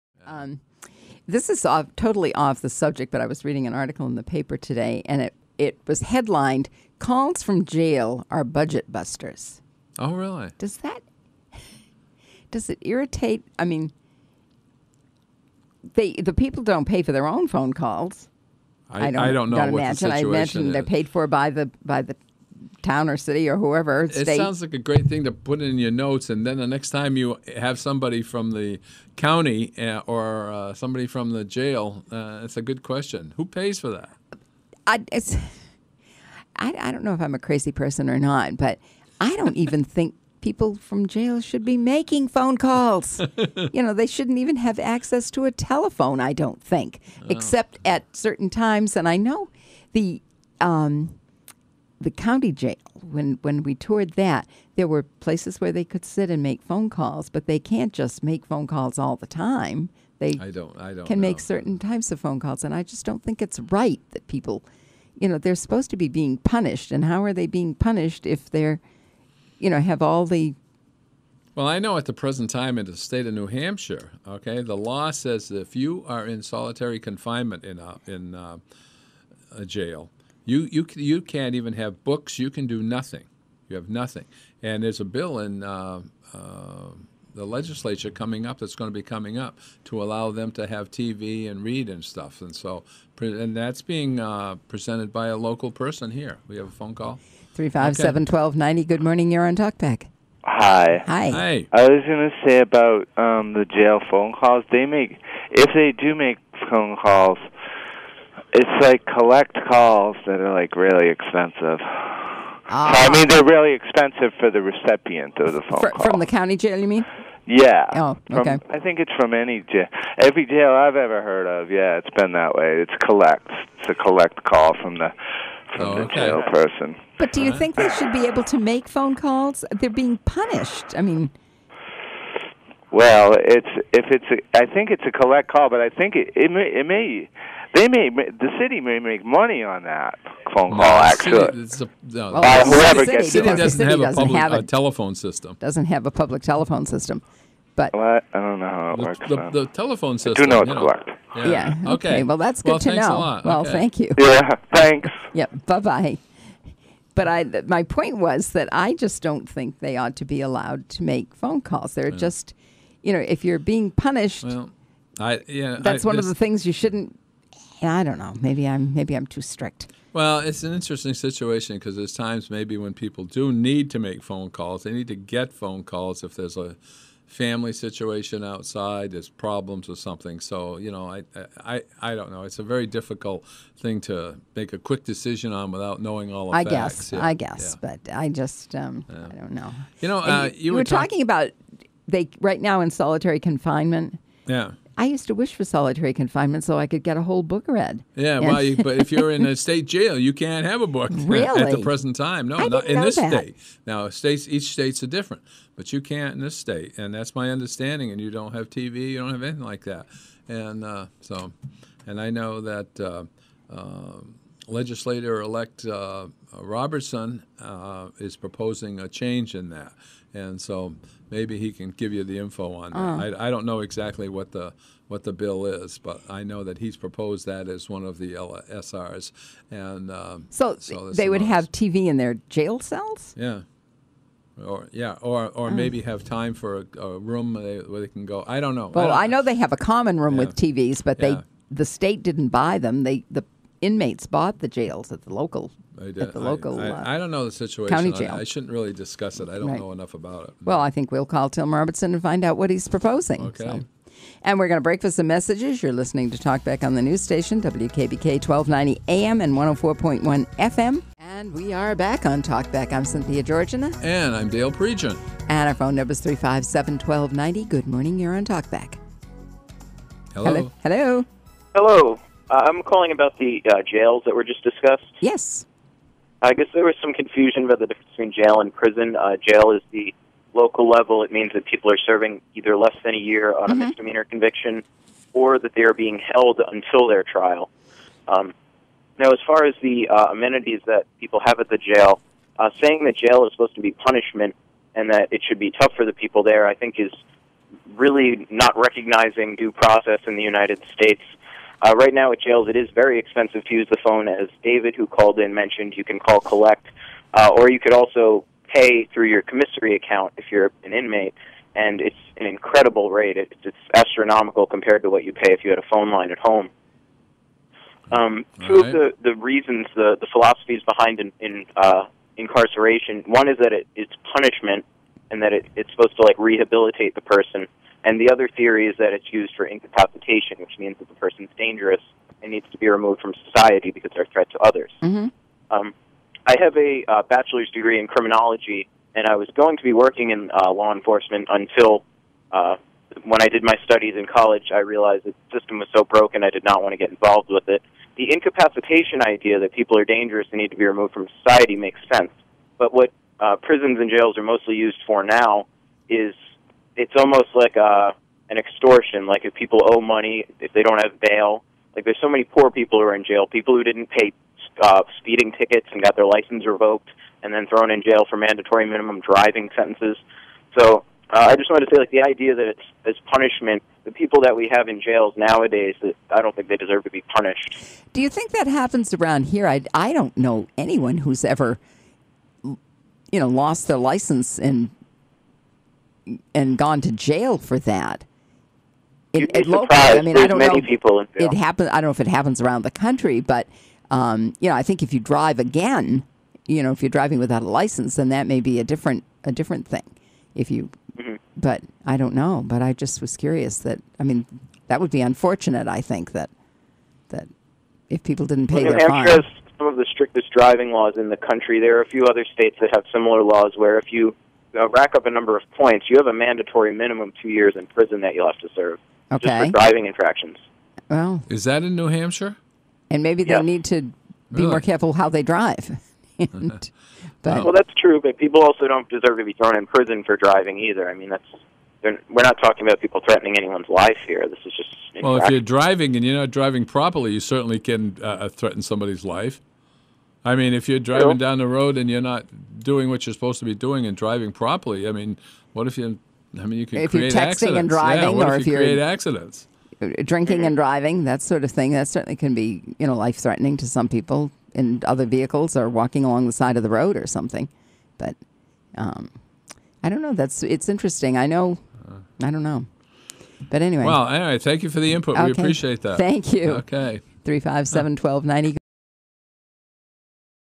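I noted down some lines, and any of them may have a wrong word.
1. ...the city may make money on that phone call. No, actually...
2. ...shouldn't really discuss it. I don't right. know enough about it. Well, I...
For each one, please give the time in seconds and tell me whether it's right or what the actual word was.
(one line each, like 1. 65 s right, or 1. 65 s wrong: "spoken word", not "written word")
1. 138 s right
2. 248 s right.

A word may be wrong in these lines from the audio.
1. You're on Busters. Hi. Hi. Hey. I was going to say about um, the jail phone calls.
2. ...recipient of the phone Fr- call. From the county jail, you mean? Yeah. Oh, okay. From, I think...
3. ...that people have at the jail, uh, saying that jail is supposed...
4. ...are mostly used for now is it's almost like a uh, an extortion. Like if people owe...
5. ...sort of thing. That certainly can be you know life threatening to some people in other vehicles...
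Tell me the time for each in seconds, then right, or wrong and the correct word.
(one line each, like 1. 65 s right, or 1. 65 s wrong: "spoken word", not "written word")
1. 99 s wrong: "TalkBack", not "Busters"
2. 114 s right
3. 290 s right
4. 354 s right
5. 451 s right.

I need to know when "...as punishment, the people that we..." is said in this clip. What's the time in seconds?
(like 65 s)
373 s.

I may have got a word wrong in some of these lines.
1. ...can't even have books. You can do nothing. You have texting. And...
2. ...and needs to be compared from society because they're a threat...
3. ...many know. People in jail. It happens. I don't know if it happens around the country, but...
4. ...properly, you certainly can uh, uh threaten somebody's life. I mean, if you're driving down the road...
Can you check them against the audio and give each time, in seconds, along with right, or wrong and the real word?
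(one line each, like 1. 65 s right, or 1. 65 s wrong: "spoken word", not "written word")
1. 81 s wrong: "nothing", not "texting"
2. 332 s wrong: "removed", not "compared"
3. 390 s right
4. 436 s right.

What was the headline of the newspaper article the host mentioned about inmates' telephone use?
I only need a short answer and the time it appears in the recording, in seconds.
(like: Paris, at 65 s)
Calls from Jail Are Budget Busters, at 6 s.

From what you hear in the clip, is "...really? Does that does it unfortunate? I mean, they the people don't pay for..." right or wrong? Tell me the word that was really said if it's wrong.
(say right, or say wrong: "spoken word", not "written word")
wrong: "irritate", not "unfortunate".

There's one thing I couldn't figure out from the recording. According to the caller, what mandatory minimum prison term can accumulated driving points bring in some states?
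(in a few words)
2 years.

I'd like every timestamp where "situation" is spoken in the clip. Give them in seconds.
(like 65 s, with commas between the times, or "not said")
171 s, 177 s, 247 s.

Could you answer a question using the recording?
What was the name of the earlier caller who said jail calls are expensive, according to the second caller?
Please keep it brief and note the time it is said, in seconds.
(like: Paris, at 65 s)
David, at 304 s.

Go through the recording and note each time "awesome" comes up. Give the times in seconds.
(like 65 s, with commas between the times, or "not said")
not said.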